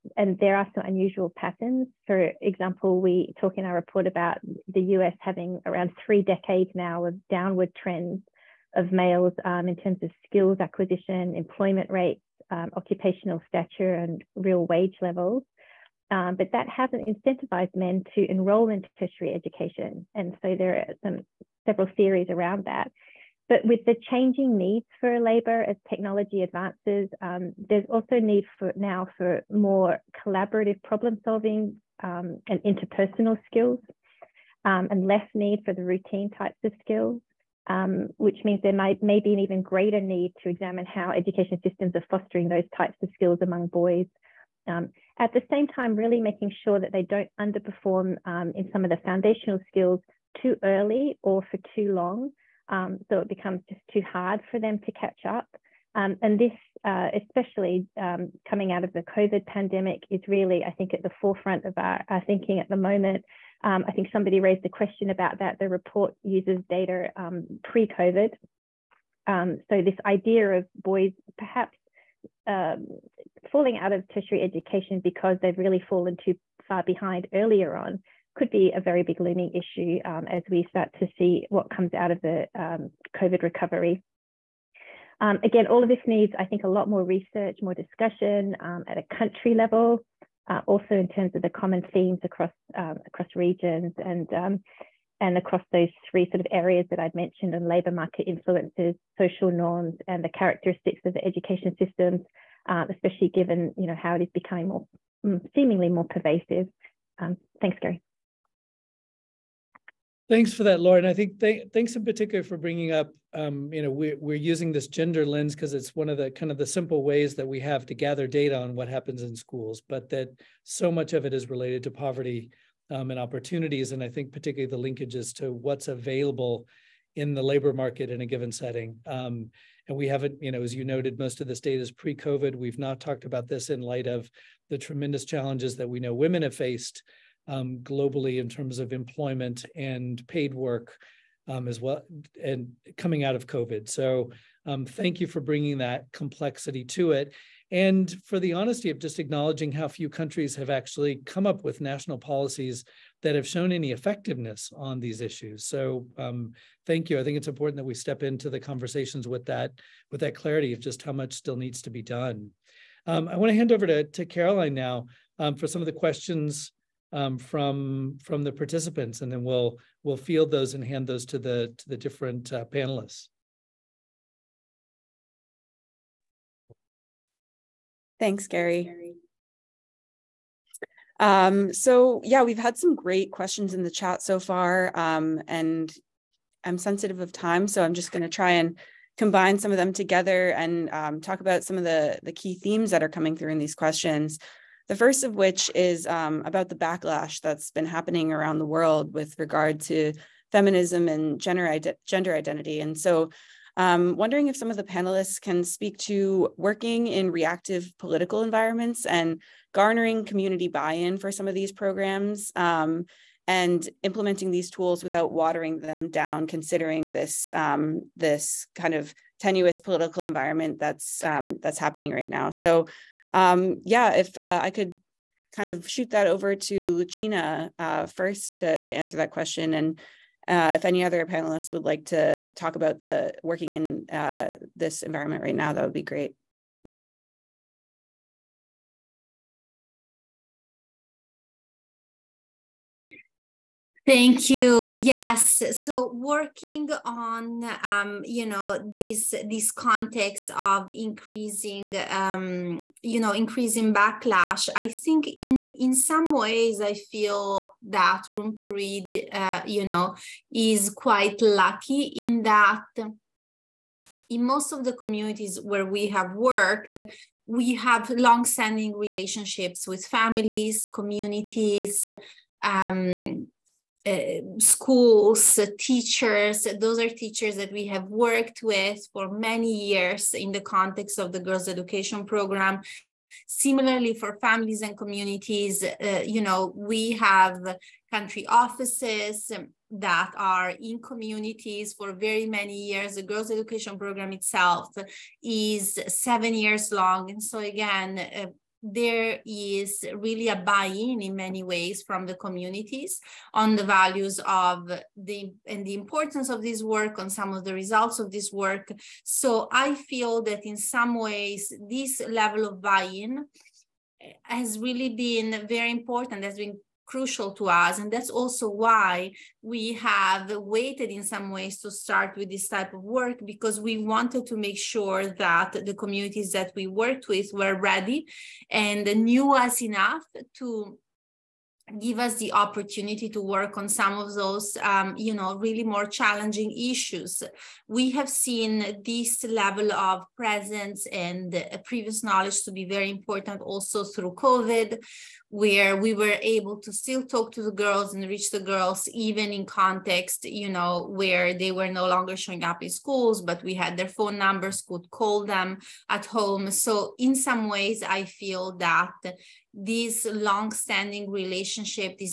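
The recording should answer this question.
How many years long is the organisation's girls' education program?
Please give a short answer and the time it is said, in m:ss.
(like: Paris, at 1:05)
7 years, at 4:56.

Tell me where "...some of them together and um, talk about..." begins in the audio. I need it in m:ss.
3:09.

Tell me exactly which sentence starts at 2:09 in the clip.
Um, and we haven't, you know, as you noted, most of this data is pre-COVID.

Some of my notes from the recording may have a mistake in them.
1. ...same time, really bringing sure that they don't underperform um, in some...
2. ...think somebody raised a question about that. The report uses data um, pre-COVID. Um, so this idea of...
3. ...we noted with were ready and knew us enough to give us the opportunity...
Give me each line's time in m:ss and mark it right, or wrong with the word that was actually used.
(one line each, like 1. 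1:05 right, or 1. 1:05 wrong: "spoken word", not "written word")
1. 0:45 wrong: "making", not "bringing"
2. 1:03 right
3. 5:26 wrong: "worked", not "noted".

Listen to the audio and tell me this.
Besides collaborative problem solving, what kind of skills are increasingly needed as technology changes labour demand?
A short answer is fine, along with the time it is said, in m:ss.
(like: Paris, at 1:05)
interpersonal skills, at 0:32.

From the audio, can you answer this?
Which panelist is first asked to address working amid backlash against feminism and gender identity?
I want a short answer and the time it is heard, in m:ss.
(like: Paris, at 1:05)
Lucina, at 3:46.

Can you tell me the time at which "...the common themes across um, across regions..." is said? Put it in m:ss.
1:31.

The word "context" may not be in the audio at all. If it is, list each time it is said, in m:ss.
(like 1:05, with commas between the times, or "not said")
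4:09, 4:40, 5:49.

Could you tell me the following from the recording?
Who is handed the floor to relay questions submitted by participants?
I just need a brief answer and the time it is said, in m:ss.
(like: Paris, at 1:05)
Caroline, at 2:44.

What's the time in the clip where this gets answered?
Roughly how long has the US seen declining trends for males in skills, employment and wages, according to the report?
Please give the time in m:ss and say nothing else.
0:06.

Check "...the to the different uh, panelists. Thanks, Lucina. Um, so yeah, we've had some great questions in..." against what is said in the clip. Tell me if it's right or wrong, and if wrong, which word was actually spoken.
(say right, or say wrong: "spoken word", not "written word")
wrong: "Gary", not "Lucina".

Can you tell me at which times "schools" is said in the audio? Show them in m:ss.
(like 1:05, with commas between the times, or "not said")
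1:59, 4:34, 5:52.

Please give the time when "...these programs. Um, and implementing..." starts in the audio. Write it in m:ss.
3:31.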